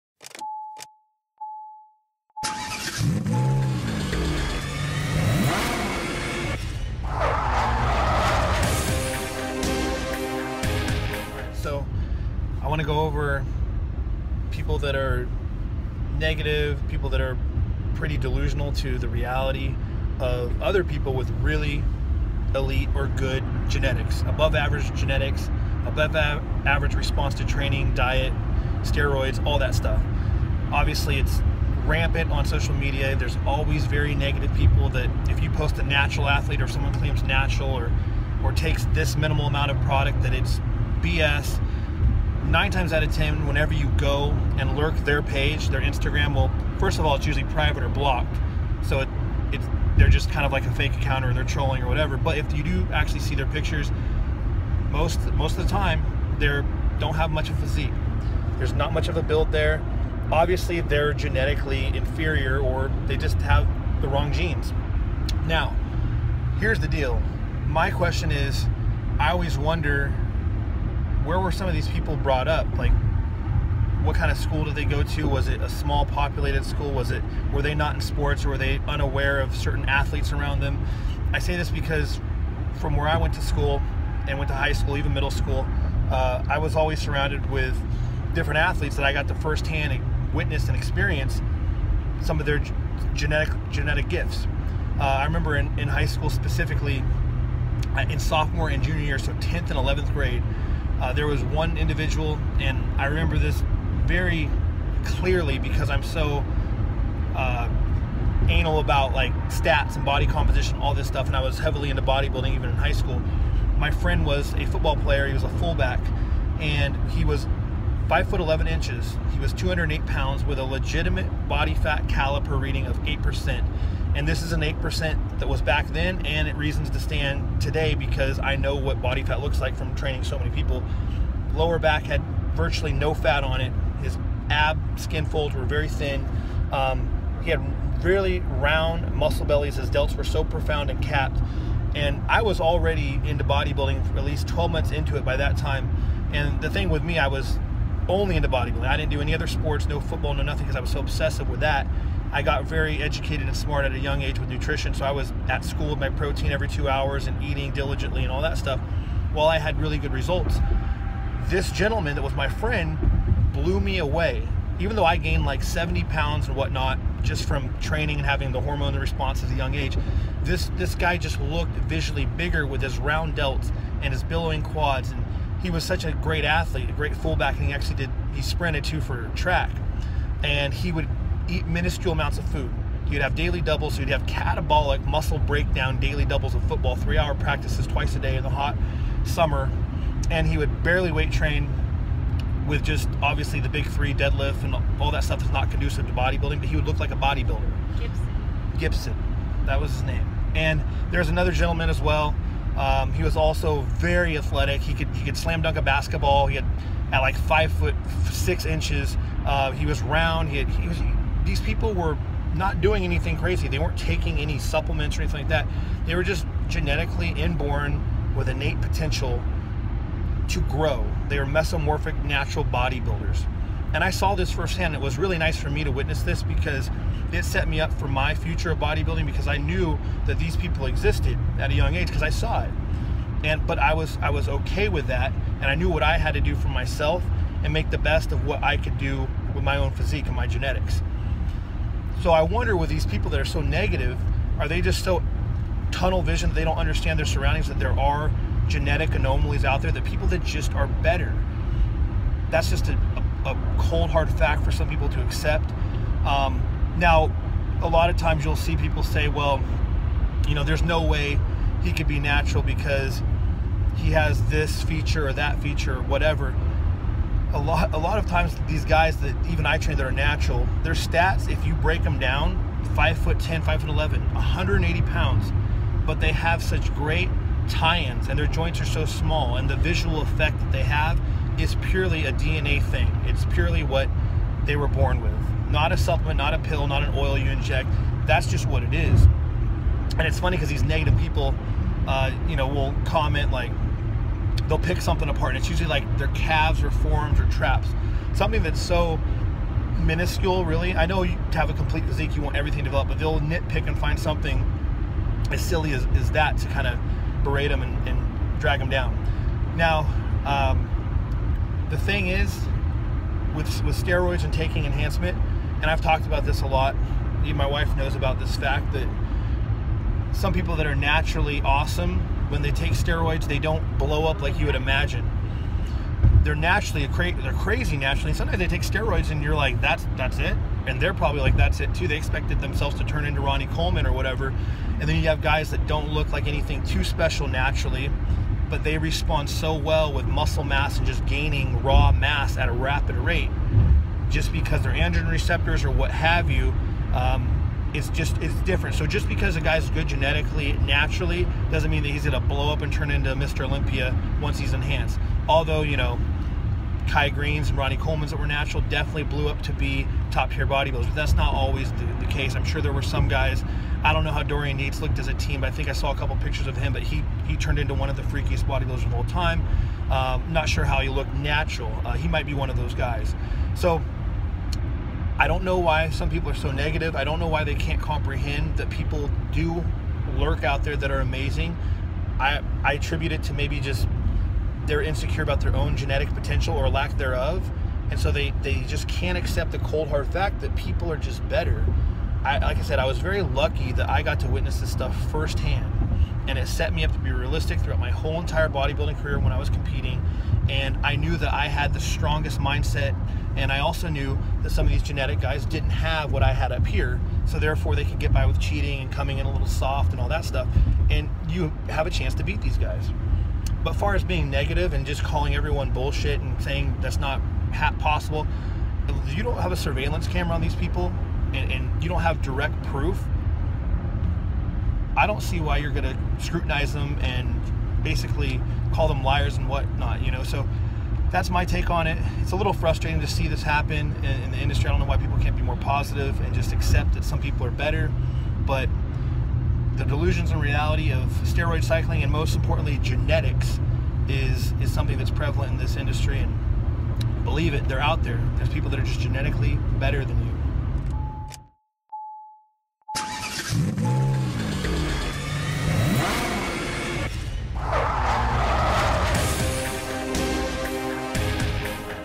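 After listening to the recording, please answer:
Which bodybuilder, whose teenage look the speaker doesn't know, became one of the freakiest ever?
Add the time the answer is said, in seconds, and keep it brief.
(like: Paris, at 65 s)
Dorian Yates, at 364 s.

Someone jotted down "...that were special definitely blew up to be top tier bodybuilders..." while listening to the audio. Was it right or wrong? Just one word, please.
wrong.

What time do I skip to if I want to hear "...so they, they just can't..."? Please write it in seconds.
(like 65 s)
388 s.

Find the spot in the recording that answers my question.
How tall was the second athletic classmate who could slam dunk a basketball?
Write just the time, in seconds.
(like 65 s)
207 s.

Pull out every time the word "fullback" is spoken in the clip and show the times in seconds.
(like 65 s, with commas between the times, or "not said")
115 s, 177 s.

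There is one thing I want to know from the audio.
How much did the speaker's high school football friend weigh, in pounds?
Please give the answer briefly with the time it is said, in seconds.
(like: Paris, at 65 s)
208, at 119 s.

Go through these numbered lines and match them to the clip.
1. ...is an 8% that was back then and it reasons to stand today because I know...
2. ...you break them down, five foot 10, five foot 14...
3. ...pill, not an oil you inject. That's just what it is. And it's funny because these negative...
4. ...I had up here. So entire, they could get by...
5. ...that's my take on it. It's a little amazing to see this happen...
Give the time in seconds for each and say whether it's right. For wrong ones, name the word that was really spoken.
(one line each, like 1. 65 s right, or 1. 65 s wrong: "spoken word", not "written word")
1. 124 s right
2. 271 s wrong: "11", not "14"
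3. 286 s right
4. 406 s wrong: "therefore", not "entire"
5. 431 s wrong: "frustrating", not "amazing".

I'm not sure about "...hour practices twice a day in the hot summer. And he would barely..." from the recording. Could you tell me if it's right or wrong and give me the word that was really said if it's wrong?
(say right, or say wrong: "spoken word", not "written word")
right.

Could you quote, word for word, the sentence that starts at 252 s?
That's just a, a cold hard fact for some people to accept.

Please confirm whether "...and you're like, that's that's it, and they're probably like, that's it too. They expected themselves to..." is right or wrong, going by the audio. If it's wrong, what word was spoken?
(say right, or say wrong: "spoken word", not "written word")
right.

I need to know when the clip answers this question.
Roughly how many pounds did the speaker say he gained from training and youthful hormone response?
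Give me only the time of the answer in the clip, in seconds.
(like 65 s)
165 s.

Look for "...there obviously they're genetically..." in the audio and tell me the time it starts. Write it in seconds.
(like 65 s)
59 s.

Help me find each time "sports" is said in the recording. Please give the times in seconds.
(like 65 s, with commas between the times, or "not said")
78 s, 149 s.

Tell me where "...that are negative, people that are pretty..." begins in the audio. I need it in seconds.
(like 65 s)
14 s.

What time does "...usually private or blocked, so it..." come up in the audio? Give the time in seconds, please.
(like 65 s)
47 s.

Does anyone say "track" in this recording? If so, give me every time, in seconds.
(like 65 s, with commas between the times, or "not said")
179 s.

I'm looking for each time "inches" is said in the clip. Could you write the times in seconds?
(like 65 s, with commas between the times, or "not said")
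118 s, 208 s.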